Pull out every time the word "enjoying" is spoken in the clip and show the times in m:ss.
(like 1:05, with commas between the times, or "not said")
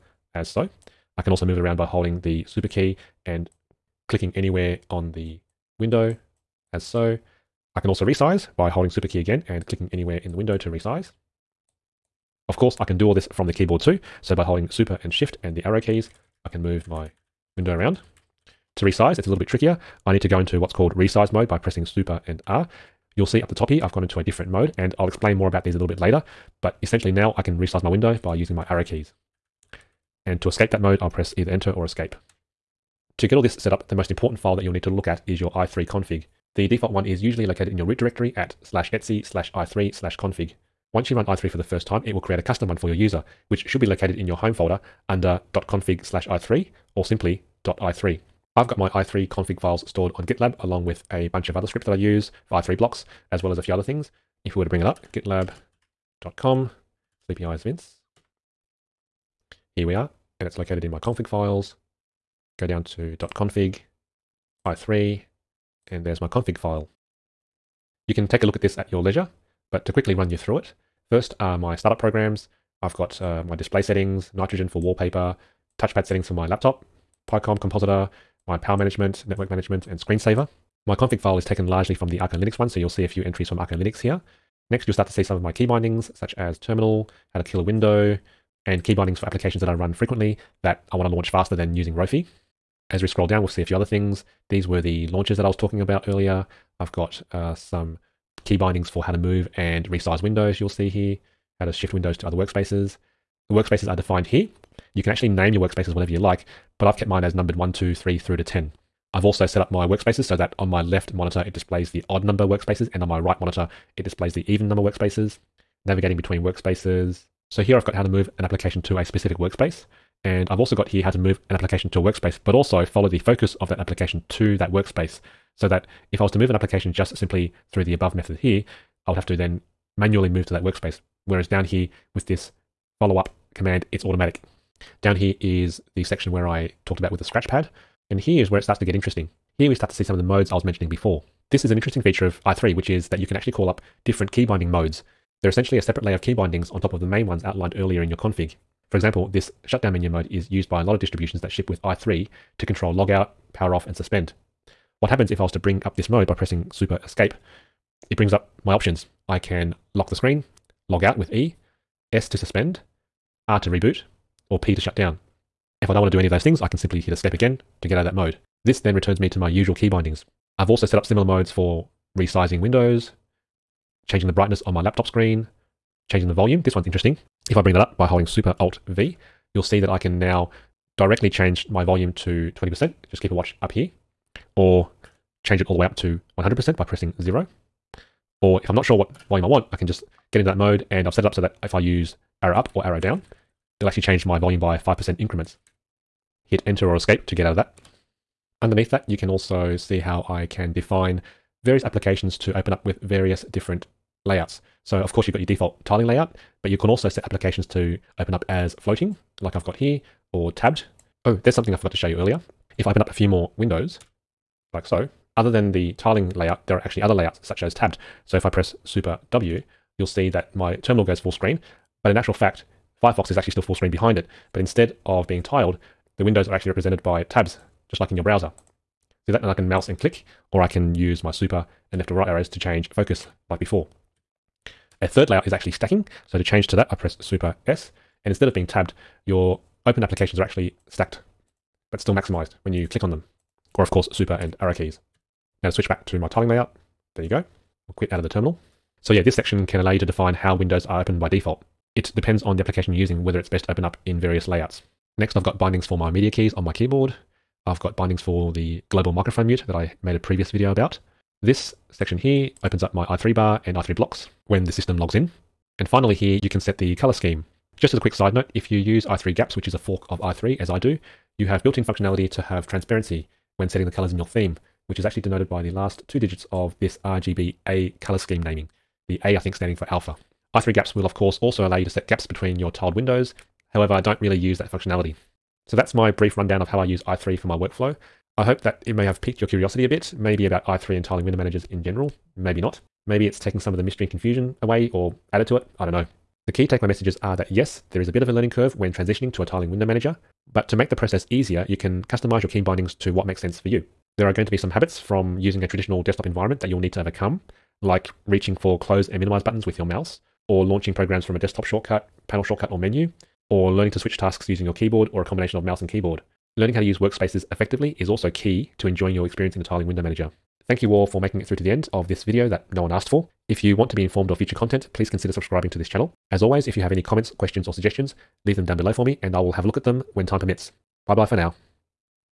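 5:18.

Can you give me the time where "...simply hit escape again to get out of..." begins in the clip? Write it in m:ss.
2:46.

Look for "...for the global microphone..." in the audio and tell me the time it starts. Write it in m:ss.
4:18.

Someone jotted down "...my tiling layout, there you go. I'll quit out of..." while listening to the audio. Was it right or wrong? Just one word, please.
right.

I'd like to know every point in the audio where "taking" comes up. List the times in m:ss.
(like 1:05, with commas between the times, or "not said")
4:53.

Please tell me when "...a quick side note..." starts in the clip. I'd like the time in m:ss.
4:27.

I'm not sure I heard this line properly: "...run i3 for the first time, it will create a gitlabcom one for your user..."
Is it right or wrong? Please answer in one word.
wrong.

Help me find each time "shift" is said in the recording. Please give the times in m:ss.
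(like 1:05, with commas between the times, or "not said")
0:15, 1:41.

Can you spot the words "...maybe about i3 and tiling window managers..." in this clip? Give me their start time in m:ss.
4:50.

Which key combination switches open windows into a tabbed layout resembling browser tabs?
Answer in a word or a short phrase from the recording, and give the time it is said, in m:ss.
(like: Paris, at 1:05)
Super W, at 3:38.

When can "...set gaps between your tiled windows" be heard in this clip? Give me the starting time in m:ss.
4:41.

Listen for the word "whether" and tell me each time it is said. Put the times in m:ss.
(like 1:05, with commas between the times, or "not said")
4:13.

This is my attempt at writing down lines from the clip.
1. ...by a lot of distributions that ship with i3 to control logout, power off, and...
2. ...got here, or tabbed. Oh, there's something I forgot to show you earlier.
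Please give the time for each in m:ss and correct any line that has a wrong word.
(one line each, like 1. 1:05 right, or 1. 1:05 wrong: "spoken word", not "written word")
1. 2:30 right
2. 3:29 right.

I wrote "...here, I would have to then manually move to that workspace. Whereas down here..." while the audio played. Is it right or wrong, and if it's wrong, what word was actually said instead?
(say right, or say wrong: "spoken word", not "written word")
right.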